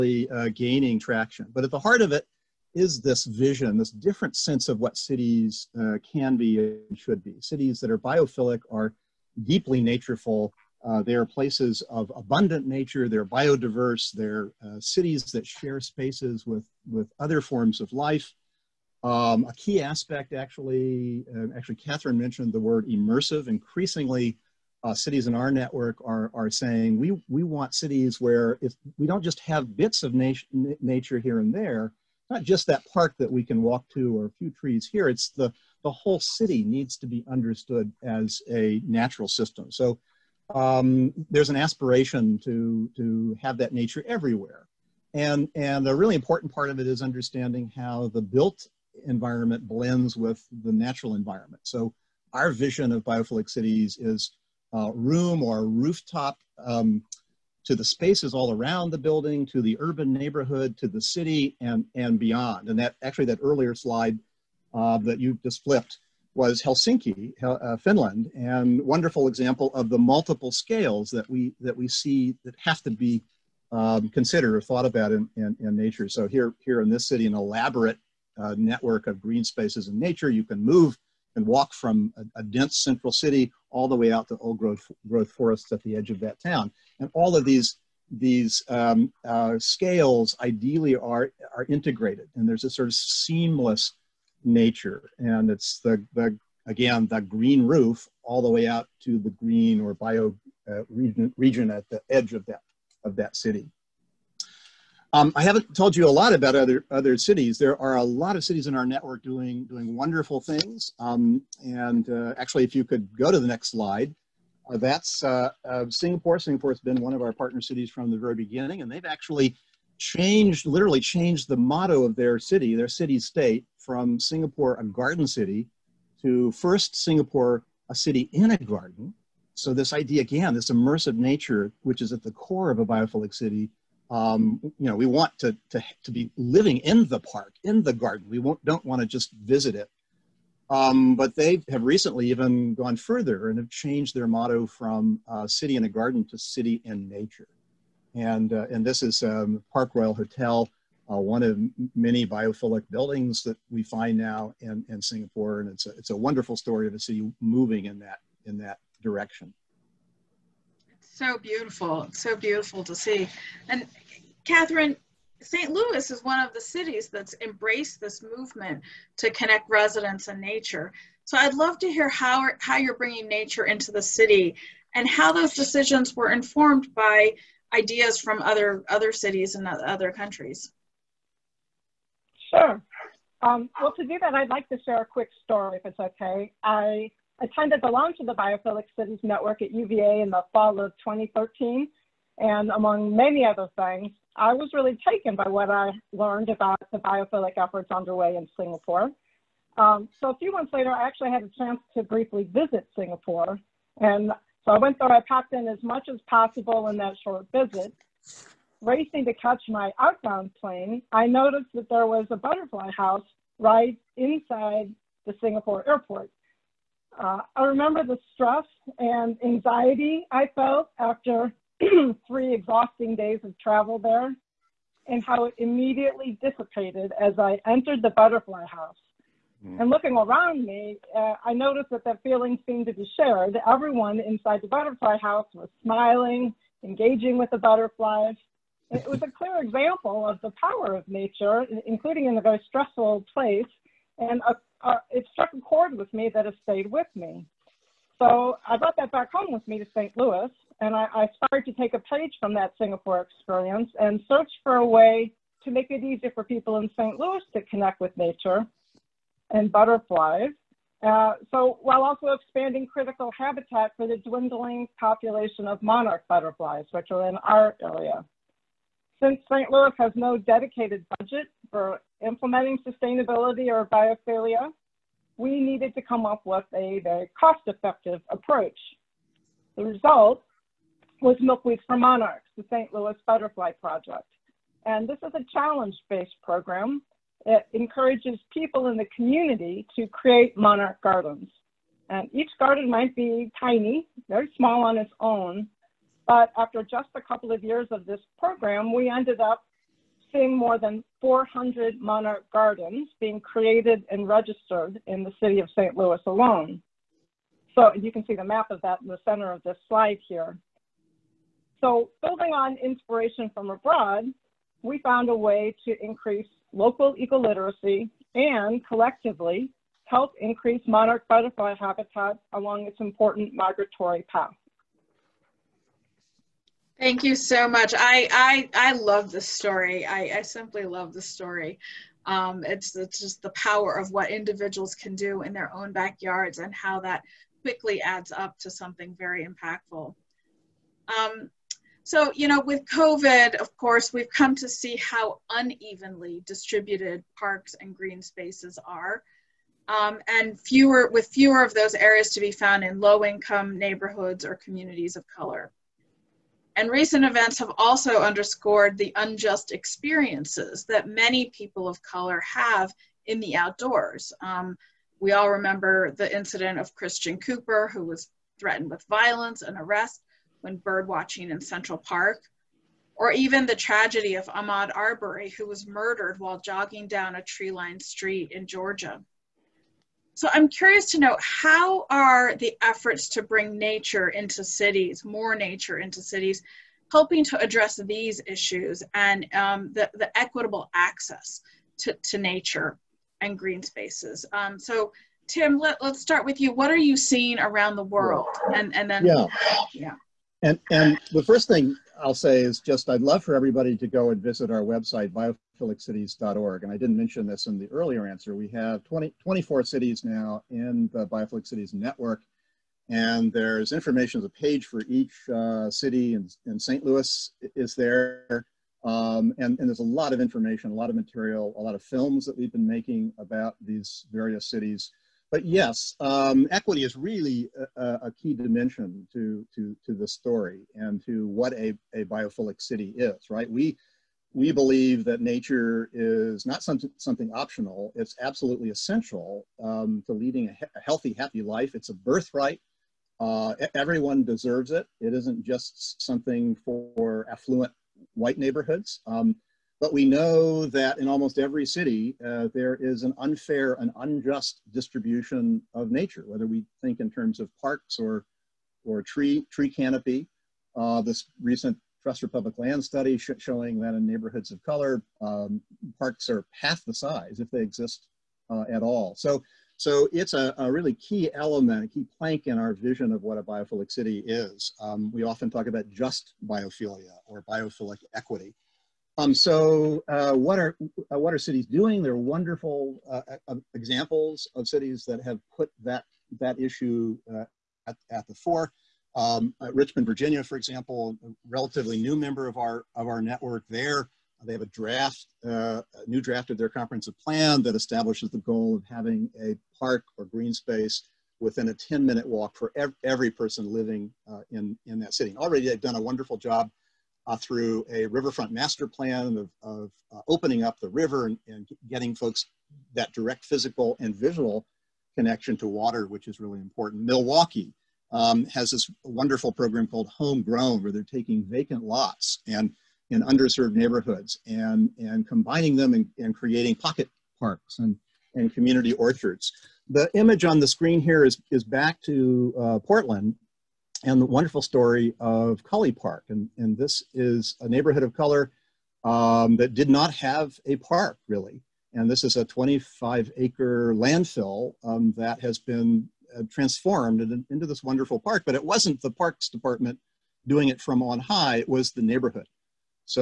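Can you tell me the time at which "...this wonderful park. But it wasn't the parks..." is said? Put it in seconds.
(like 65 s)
547 s.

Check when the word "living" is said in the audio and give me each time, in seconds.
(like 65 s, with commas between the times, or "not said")
136 s, 503 s.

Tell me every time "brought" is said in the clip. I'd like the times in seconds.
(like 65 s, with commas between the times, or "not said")
248 s.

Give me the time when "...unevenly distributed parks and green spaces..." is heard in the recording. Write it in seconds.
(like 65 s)
345 s.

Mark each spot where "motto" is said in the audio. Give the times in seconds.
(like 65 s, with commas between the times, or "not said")
121 s, 144 s.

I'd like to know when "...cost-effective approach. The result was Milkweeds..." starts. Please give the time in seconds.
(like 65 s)
277 s.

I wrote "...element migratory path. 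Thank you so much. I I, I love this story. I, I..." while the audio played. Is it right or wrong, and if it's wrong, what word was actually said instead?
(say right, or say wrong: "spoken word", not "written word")
wrong: "important", not "element".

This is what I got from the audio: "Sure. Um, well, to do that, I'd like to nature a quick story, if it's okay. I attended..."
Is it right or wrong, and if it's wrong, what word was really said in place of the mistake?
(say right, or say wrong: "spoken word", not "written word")
wrong: "share", not "nature".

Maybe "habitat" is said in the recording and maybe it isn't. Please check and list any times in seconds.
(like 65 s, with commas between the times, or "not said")
263 s, 321 s.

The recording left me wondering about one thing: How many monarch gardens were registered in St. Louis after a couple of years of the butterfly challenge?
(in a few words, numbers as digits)
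400.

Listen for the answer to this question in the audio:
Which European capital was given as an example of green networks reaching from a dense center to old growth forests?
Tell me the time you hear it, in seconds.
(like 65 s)
66 s.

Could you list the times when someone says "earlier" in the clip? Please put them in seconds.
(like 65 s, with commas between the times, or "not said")
63 s, 407 s.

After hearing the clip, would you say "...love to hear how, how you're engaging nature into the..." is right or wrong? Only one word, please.
wrong.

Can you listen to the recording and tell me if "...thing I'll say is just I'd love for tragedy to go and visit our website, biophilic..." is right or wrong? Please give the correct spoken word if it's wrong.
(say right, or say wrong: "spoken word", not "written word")
wrong: "everybody", not "tragedy".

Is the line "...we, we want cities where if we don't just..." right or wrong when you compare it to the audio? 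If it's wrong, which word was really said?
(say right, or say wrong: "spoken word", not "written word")
right.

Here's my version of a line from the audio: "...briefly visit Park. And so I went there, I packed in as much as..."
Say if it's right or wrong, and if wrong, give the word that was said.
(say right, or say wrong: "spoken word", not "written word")
wrong: "Singapore", not "Park".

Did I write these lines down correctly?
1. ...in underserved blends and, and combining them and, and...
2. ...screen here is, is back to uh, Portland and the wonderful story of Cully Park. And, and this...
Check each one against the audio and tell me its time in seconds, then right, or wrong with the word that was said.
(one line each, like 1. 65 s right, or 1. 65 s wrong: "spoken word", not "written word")
1. 523 s wrong: "neighborhoods", not "blends"
2. 530 s right.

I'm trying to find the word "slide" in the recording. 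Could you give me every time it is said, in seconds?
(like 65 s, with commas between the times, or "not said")
63 s, 113 s, 309 s.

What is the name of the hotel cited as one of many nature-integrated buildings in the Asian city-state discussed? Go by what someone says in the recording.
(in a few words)
Park Royal Hotel.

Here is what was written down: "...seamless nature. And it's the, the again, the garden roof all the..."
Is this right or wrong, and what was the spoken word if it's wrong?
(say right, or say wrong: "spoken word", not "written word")
wrong: "green", not "garden".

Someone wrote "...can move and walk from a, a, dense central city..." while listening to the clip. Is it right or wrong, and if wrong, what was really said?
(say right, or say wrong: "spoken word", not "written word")
right.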